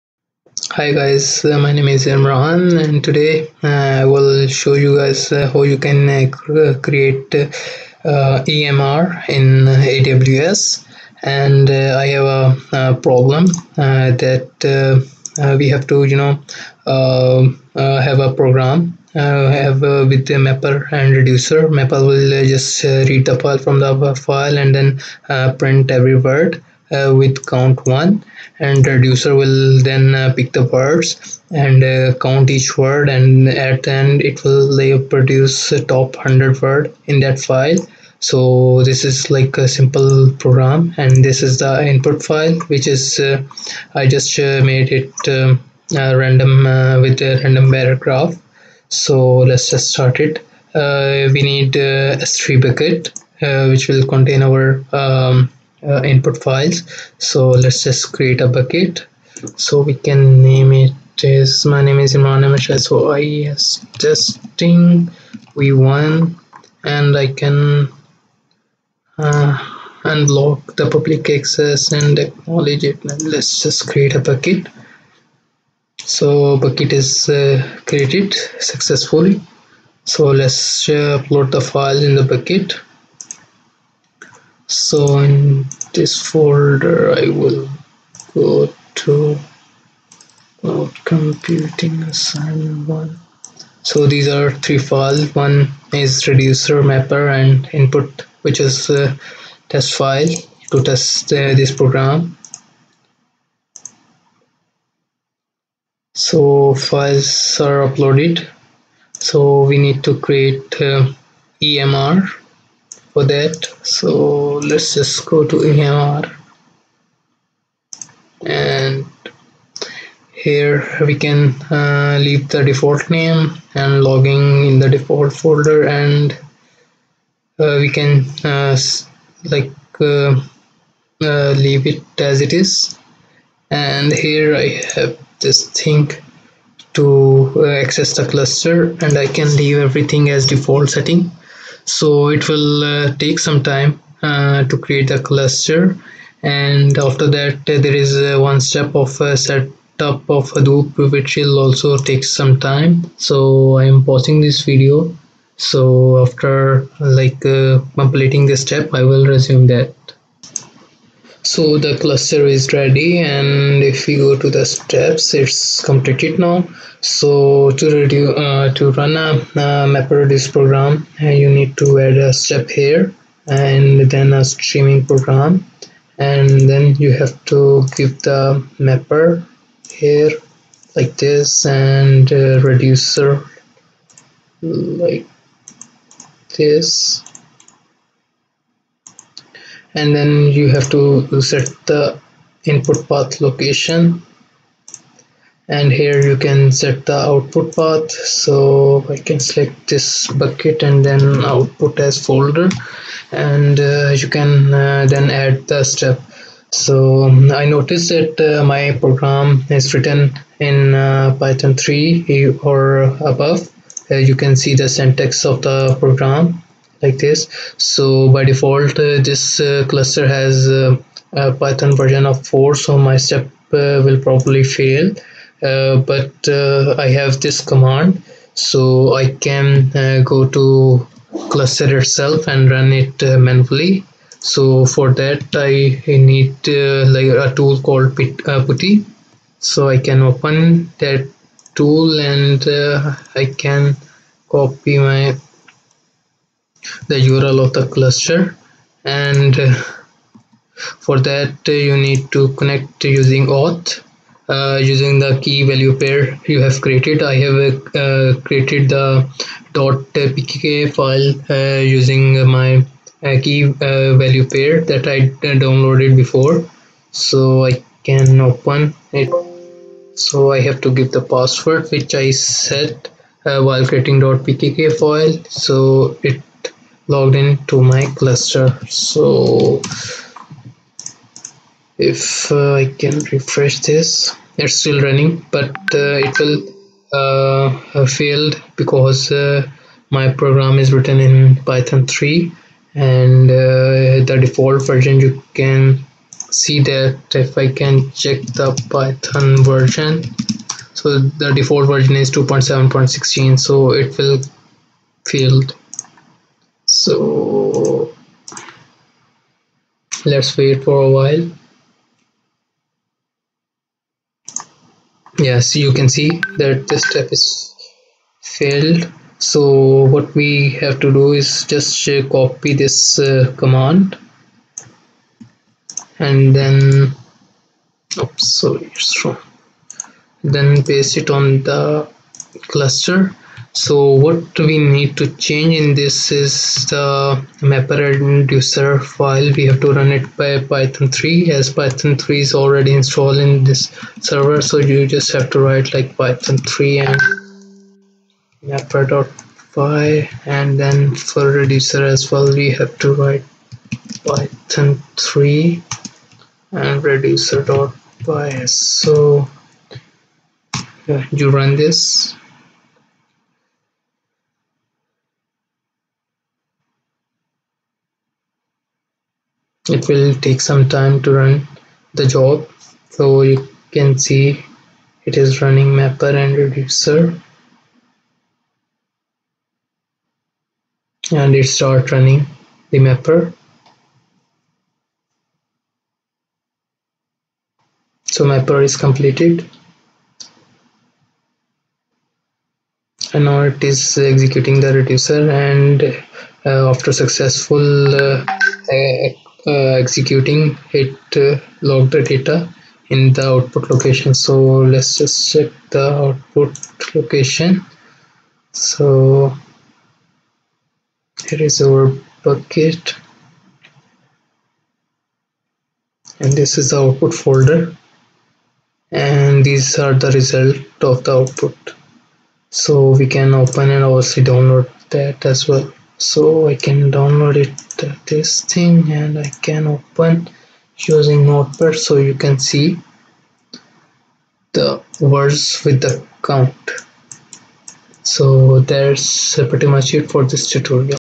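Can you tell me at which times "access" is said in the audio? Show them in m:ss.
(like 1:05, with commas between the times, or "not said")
1:11, 2:17.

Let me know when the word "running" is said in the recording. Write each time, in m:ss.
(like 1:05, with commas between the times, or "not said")
4:45, 6:15, 6:22.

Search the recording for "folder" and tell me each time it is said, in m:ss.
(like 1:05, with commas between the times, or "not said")
1:26, 2:05, 3:22, 6:57.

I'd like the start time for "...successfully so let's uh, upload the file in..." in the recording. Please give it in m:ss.
1:18.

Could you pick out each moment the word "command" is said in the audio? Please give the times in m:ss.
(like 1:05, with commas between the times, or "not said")
3:47, 5:23.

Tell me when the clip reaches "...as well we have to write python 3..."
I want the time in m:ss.
5:52.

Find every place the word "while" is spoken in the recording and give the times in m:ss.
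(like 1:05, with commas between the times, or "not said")
4:33, 5:11.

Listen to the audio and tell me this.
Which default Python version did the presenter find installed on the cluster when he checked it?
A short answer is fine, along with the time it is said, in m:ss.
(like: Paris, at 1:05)
2.7.16, at 5:02.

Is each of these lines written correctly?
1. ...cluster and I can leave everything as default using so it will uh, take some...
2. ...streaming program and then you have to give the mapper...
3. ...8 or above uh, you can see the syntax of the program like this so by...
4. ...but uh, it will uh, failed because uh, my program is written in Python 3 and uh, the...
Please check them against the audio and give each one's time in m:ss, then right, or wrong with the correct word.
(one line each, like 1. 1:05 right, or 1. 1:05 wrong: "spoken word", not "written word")
1. 2:18 wrong: "setting", not "using"
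2. 2:54 right
3. 3:31 wrong: "3", not "8"
4. 4:45 right.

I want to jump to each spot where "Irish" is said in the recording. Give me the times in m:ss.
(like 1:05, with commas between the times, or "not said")
not said.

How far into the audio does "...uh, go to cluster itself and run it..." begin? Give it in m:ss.
3:49.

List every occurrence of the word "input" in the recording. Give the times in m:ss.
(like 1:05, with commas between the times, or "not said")
0:41, 0:56, 1:37, 3:12.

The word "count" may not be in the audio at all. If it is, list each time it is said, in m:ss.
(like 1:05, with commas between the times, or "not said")
0:27, 0:32, 7:16.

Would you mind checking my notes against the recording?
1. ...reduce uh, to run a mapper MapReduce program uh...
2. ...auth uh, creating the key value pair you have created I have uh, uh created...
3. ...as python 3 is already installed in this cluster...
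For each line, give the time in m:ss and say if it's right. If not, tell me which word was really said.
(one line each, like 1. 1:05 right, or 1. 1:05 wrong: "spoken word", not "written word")
1. 2:48 right
2. 4:13 wrong: "using", not "creating"
3. 5:41 wrong: "server", not "cluster".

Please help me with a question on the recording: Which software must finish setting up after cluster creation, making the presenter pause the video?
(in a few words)
Hadoop.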